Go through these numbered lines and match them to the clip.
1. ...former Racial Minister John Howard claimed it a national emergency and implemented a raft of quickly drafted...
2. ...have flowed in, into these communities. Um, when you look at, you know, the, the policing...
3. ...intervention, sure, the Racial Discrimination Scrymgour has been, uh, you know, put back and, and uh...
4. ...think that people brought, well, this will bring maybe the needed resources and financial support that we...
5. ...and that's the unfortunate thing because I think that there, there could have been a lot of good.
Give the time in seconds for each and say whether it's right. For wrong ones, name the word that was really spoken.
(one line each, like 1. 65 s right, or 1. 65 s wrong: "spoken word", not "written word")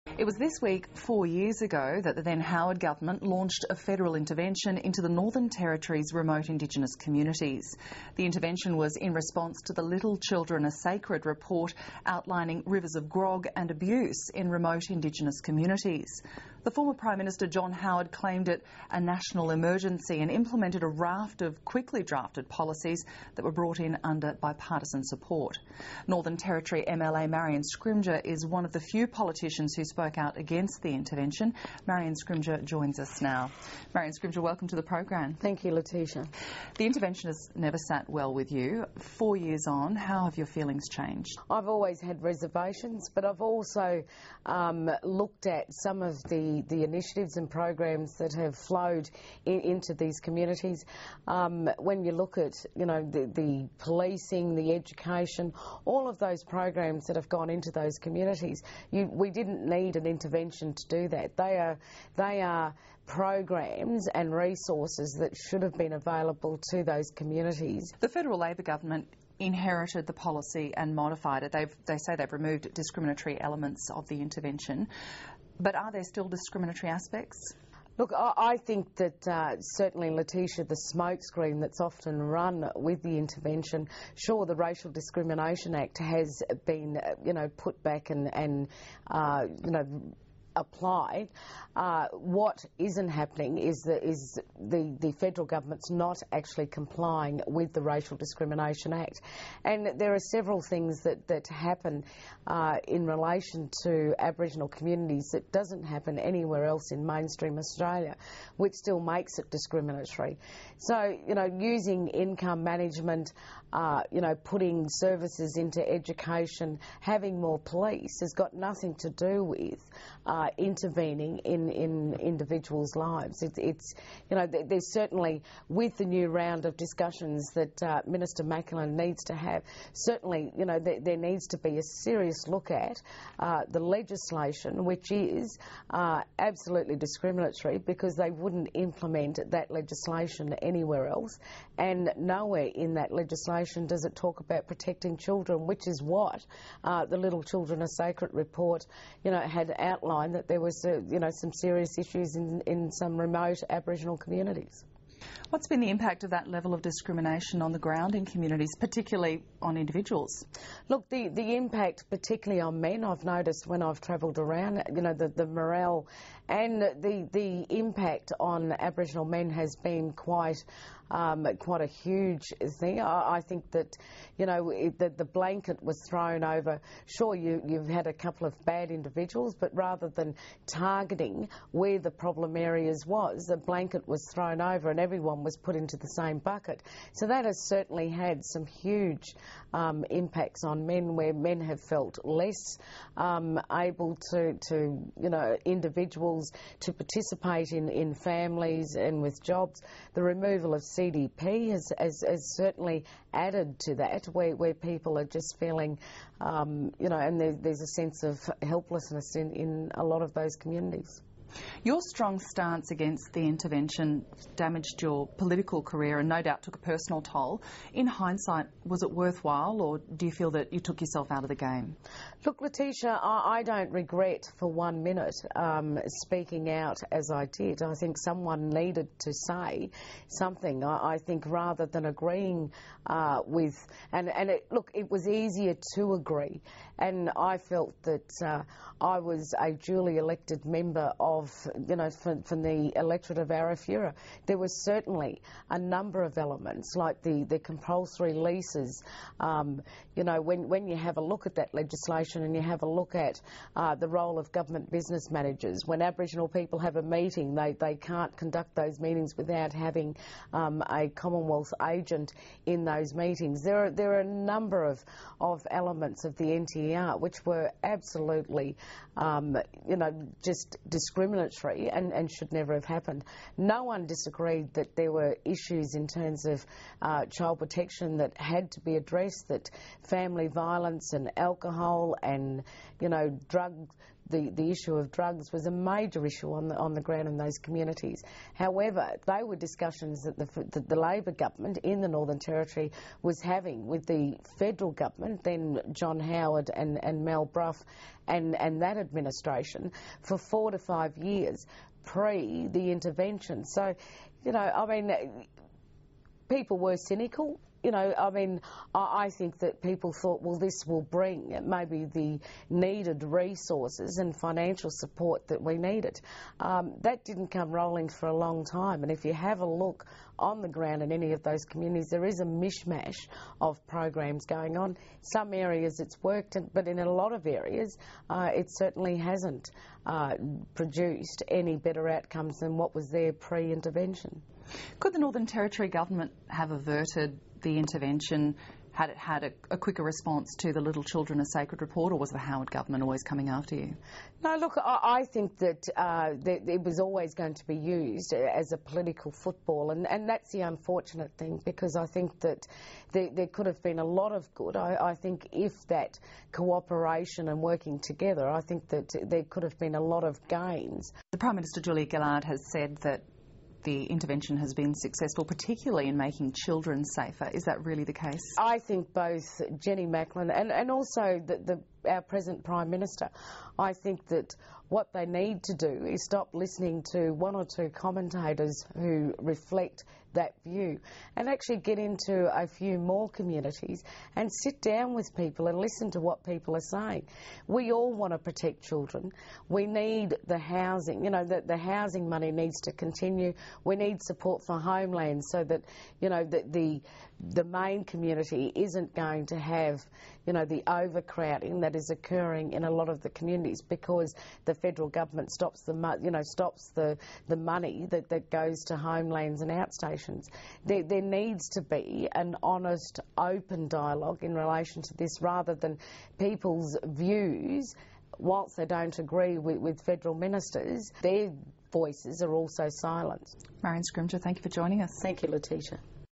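1. 16 s wrong: "Prime", not "Racial"
2. 48 s right
3. 83 s wrong: "Act", not "Scrymgour"
4. 309 s wrong: "thought", not "brought"
5. 350 s right.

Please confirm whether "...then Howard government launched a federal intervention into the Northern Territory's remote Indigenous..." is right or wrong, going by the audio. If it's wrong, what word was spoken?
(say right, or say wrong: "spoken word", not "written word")
right.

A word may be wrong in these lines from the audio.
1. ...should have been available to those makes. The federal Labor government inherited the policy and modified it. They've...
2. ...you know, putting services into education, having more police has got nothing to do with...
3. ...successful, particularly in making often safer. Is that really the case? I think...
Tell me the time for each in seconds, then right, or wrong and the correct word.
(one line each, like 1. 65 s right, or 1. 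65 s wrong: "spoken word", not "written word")
1. 65 s wrong: "communities", not "makes"
2. 114 s right
3. 364 s wrong: "children", not "often".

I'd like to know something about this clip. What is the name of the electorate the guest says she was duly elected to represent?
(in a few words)
Arafura.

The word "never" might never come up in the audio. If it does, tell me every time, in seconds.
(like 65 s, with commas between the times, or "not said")
37 s, 272 s.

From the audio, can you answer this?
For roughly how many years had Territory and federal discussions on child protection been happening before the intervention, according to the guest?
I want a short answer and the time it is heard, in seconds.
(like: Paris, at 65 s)
4 to 5 years, at 300 s.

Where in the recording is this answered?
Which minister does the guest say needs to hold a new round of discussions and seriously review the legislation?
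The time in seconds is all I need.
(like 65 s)
128 s.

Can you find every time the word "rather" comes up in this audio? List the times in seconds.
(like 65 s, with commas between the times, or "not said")
179 s, 231 s, 415 s.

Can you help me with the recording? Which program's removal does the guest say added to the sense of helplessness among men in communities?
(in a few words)
CDP.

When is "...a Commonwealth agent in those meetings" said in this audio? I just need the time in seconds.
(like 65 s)
260 s.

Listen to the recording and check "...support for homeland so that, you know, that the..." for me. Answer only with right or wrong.
right.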